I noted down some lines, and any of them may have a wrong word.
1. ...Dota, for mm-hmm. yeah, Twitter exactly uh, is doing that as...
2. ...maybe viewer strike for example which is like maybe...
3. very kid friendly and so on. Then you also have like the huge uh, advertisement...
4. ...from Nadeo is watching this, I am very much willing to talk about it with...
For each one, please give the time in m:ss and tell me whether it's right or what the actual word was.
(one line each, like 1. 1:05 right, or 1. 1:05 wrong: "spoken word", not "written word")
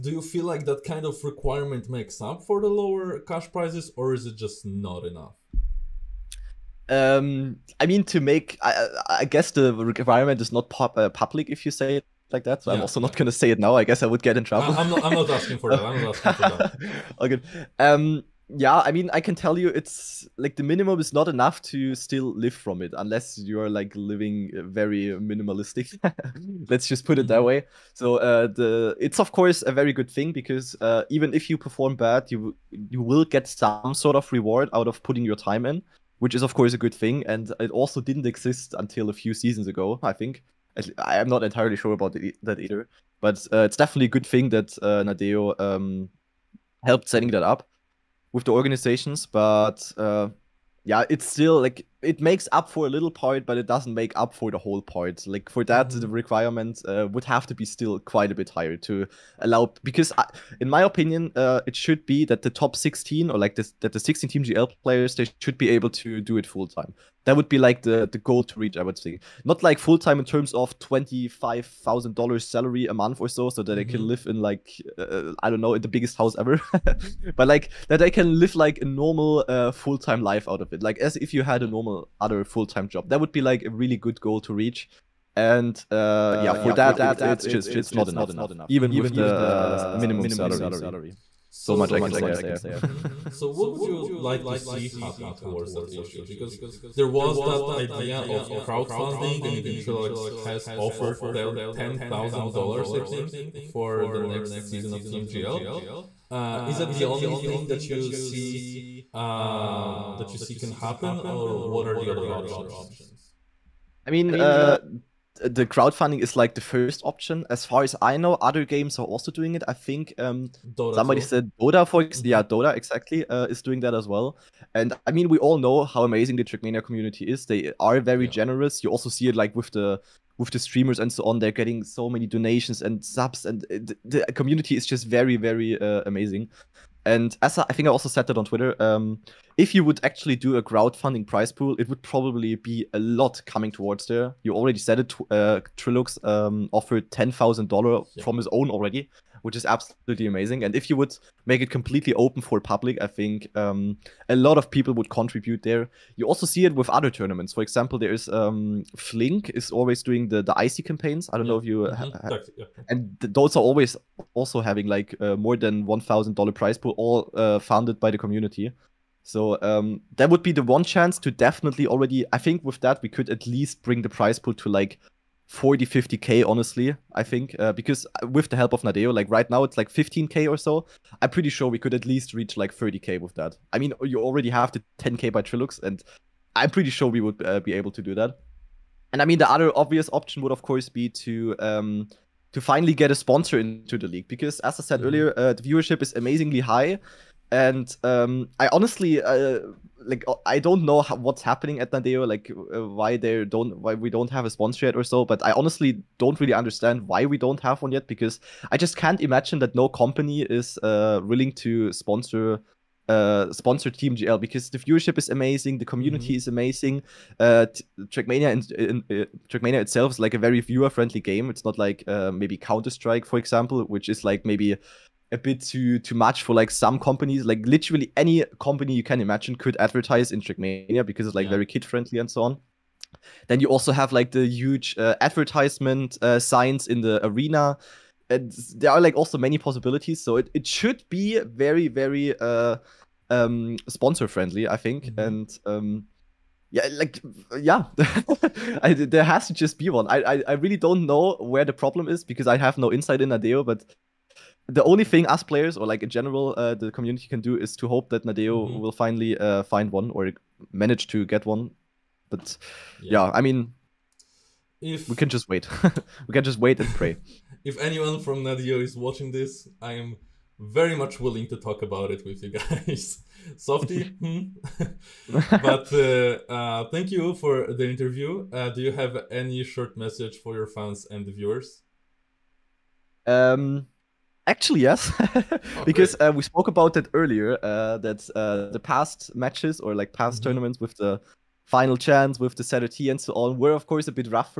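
1. 2:01 wrong: "Dota", not "Twitter"
2. 3:42 wrong: "counter", not "viewer"
3. 3:51 right
4. 4:28 right.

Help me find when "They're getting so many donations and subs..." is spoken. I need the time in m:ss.
2:11.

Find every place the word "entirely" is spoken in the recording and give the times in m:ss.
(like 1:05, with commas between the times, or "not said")
0:41.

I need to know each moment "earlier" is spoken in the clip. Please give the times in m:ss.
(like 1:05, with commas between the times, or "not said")
3:15, 4:47.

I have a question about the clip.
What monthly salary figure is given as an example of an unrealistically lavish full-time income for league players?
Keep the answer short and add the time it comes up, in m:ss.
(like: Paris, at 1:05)
$25,000, at 1:10.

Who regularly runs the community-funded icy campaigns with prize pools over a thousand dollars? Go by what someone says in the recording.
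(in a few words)
Flink.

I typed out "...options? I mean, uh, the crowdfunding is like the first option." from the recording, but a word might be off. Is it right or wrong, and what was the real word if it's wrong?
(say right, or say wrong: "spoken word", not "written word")
right.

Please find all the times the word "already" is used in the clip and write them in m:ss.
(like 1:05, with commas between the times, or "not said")
2:24, 2:28, 2:51, 3:04.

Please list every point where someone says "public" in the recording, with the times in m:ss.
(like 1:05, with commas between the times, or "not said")
0:11, 2:32.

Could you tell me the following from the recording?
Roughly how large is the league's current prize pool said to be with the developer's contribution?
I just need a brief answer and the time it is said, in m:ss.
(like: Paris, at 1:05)
15k, at 2:59.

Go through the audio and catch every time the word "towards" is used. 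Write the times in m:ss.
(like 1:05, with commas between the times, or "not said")
1:35, 2:23.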